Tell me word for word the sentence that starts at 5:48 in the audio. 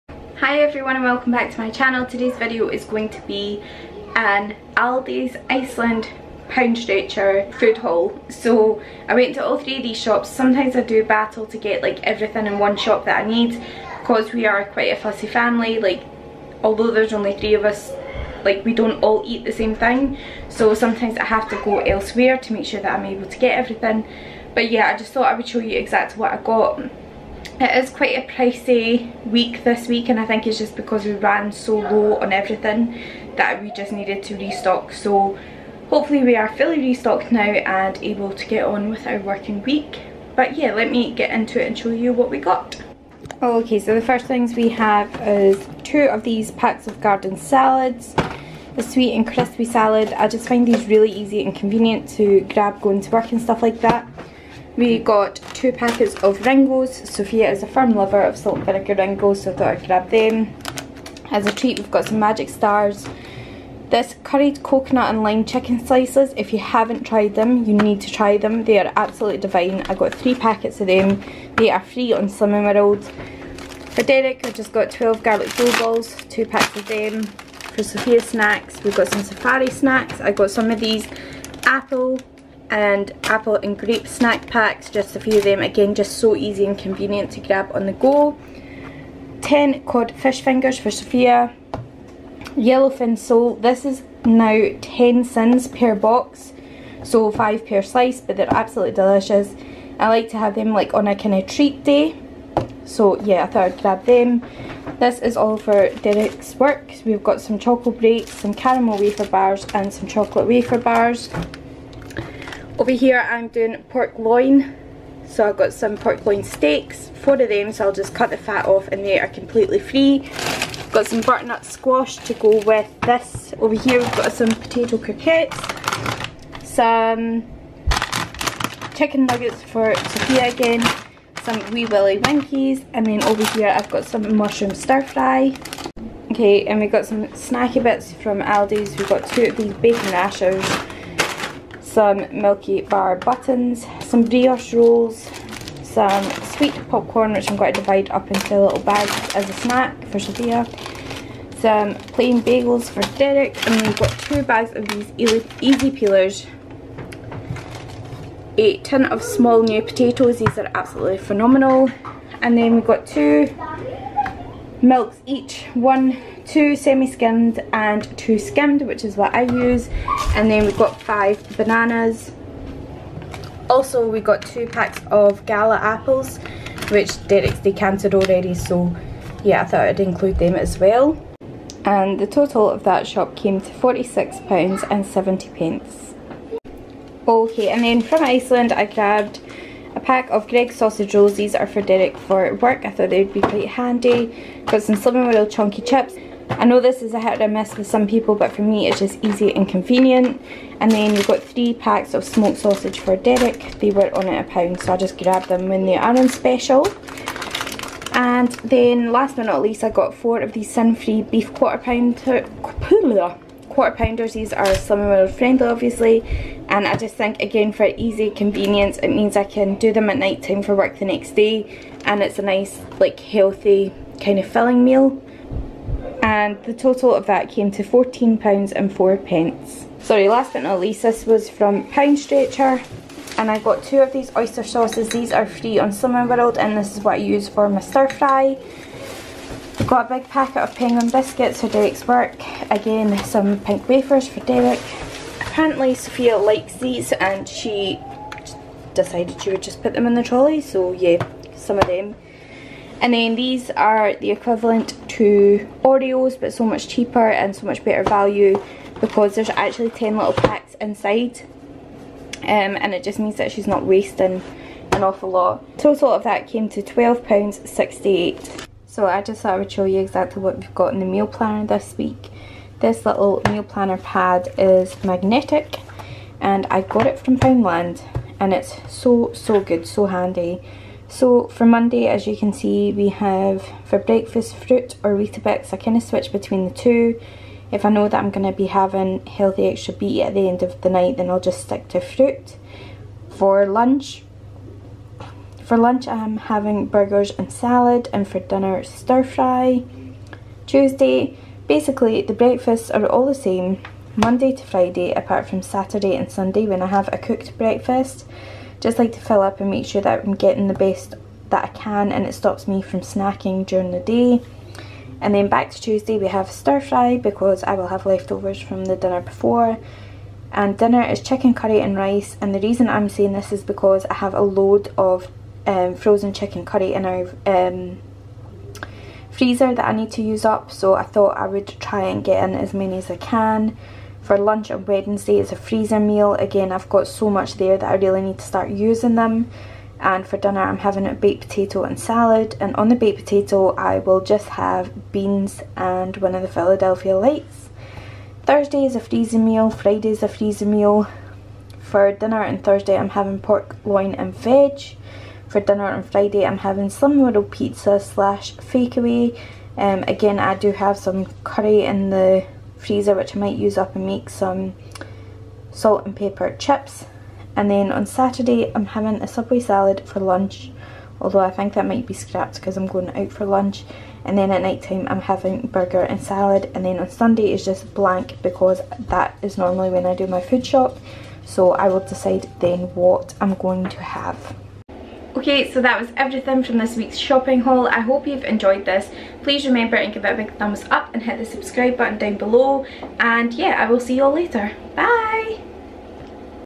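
Thursday is a freezer meal, Friday is a freezer meal.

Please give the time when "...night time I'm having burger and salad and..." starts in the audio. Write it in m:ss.
6:14.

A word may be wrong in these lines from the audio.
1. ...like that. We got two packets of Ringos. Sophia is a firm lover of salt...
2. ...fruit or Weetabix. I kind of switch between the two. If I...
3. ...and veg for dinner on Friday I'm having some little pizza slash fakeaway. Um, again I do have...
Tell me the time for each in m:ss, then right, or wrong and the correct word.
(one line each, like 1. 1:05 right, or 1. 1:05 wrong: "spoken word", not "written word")
1. 0:53 right
2. 4:44 right
3. 5:54 right.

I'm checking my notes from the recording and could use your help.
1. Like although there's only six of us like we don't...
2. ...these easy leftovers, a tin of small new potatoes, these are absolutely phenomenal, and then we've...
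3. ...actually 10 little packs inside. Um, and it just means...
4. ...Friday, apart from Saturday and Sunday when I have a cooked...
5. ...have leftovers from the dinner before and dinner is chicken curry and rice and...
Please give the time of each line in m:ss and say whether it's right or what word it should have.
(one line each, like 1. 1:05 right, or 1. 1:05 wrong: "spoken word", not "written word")
1. 0:15 wrong: "three", not "six"
2. 2:34 wrong: "peelers", not "leftovers"
3. 4:19 right
4. 5:04 right
5. 5:17 right.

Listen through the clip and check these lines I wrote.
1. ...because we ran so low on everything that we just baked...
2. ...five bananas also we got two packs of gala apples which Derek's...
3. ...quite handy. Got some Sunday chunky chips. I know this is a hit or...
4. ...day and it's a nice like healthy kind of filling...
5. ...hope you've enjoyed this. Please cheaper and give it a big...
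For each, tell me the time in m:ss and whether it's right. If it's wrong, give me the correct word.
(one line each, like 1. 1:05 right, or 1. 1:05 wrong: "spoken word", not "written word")
1. 0:30 wrong: "needed", not "baked"
2. 2:51 right
3. 3:13 wrong: "World", not "Sunday"
4. 3:41 right
5. 6:28 wrong: "remember", not "cheaper".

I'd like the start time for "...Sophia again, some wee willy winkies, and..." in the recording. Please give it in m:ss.
2:09.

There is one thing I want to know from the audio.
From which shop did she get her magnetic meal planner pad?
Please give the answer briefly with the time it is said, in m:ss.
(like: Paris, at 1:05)
Poundland, at 4:37.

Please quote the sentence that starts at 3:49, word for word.
Sorry last but not least this was from Pound Stretcher and I got two of these oyster sauces.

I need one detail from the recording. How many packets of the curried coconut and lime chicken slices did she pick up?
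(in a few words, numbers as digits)
3.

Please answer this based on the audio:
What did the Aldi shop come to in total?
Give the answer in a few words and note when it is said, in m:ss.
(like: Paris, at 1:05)
£46.70, at 3:03.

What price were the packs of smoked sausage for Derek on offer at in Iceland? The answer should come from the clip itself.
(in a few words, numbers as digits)
A pound.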